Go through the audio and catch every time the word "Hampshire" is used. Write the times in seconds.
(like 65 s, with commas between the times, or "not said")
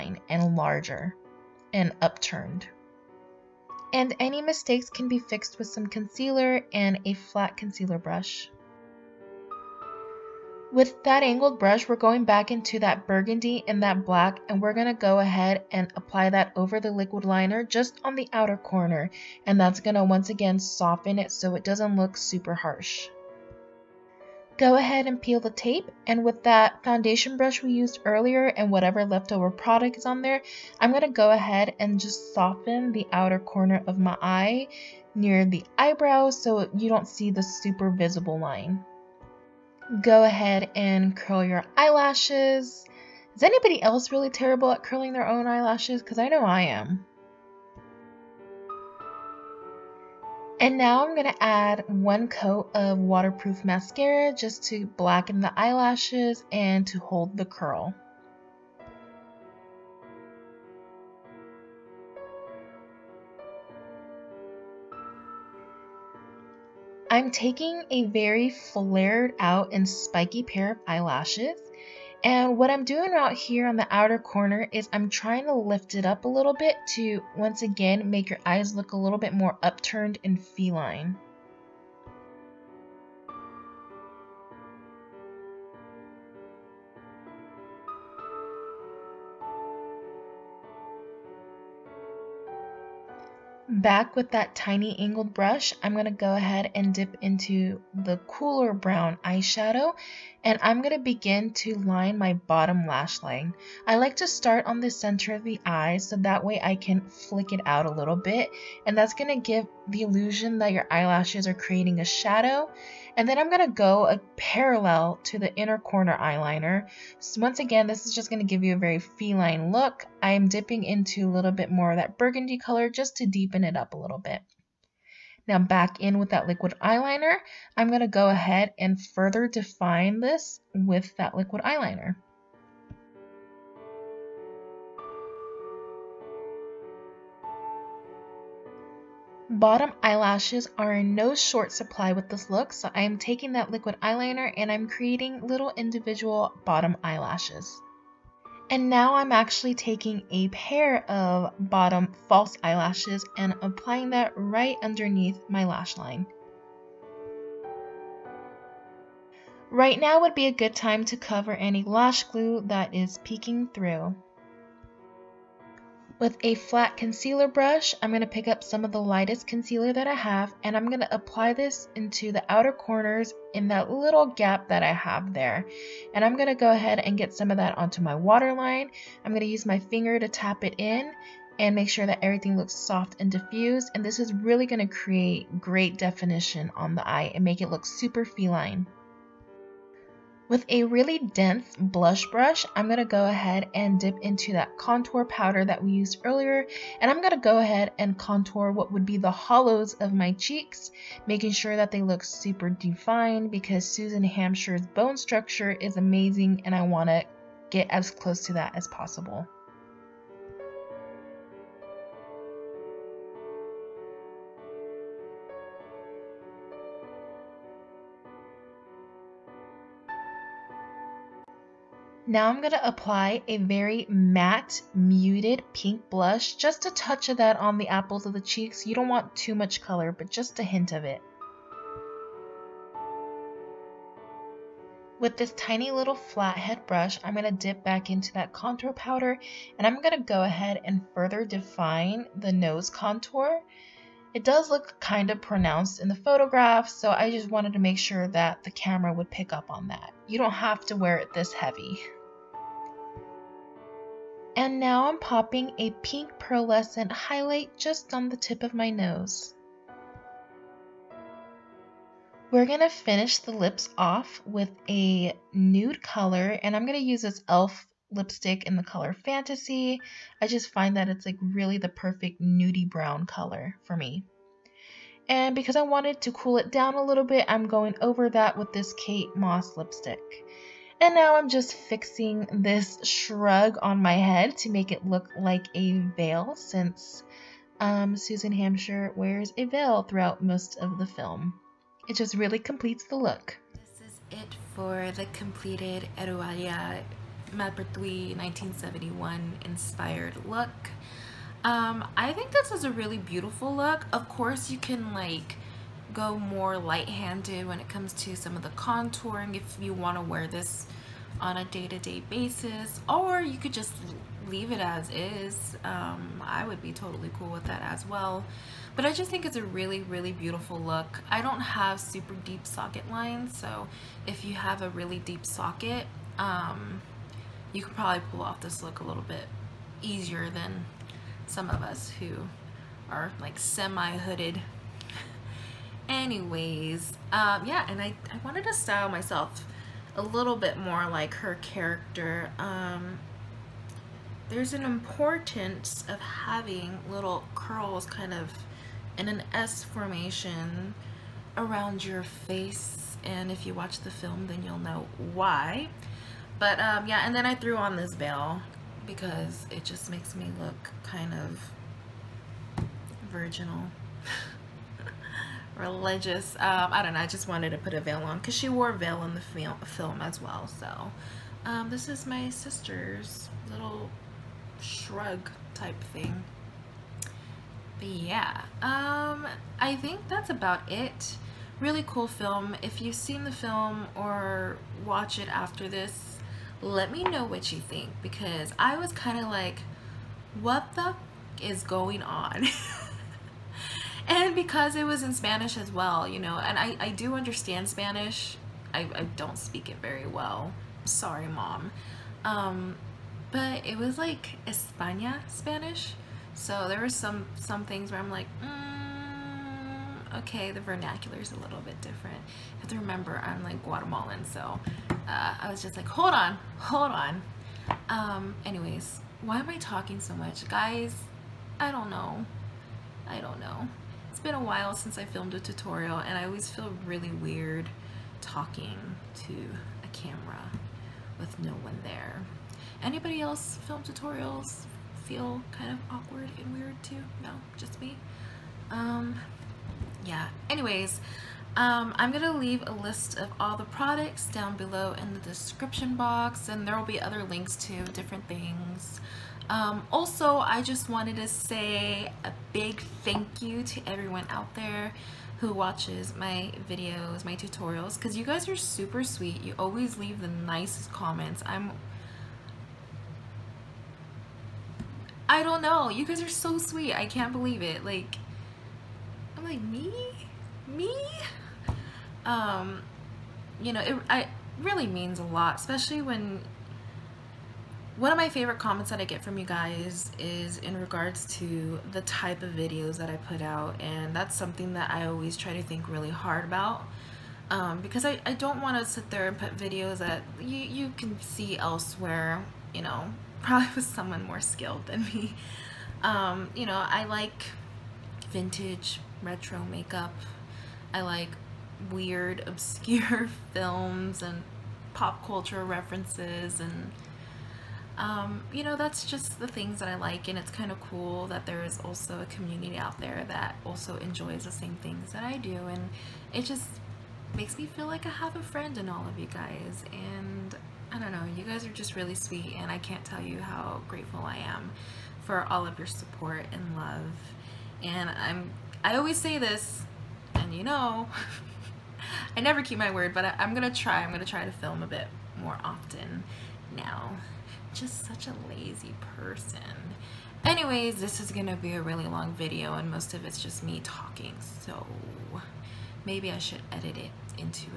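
204 s, 288 s.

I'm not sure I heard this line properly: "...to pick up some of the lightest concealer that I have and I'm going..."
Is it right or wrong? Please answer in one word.
right.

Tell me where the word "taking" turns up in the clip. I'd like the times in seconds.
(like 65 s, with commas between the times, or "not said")
67 s, 143 s, 149 s.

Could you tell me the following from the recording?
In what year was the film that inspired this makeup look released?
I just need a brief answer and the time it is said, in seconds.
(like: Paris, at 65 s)
1971, at 298 s.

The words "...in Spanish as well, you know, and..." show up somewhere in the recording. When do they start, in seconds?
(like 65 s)
395 s.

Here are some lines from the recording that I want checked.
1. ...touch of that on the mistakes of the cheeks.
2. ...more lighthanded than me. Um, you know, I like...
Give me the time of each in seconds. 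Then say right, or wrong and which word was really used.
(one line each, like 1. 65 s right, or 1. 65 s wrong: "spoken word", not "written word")
1. 226 s wrong: "apples", not "mistakes"
2. 494 s wrong: "skilled", not "lighthanded".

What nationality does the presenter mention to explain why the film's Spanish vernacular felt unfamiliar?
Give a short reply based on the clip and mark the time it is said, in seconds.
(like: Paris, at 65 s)
Guatemalan, at 413 s.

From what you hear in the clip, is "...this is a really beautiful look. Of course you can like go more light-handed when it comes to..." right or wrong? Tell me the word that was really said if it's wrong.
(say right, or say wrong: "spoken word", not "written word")
right.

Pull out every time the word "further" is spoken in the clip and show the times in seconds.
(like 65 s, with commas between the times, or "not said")
128 s, 241 s.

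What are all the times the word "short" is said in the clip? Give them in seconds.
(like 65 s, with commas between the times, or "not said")
141 s.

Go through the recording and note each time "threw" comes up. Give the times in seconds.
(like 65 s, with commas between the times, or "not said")
357 s.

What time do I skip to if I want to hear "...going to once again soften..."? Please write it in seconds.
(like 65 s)
19 s.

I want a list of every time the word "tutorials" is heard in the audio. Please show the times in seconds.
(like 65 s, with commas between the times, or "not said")
425 s, 434 s, 457 s.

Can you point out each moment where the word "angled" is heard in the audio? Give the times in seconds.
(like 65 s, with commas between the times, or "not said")
11 s, 94 s.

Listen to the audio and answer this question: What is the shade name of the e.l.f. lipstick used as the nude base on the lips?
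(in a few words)
Fantasy.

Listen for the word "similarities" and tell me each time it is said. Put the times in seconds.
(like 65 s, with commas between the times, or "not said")
not said.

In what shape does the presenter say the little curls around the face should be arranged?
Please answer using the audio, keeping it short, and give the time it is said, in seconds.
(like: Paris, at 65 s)
S formation, at 349 s.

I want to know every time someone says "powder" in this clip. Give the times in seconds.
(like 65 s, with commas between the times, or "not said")
195 s, 238 s.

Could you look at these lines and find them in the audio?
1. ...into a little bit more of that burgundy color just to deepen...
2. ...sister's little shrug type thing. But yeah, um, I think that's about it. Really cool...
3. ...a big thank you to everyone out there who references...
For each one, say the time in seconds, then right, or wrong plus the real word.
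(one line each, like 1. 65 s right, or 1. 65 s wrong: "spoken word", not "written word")
1. 120 s right
2. 372 s right
3. 452 s wrong: "watches", not "references".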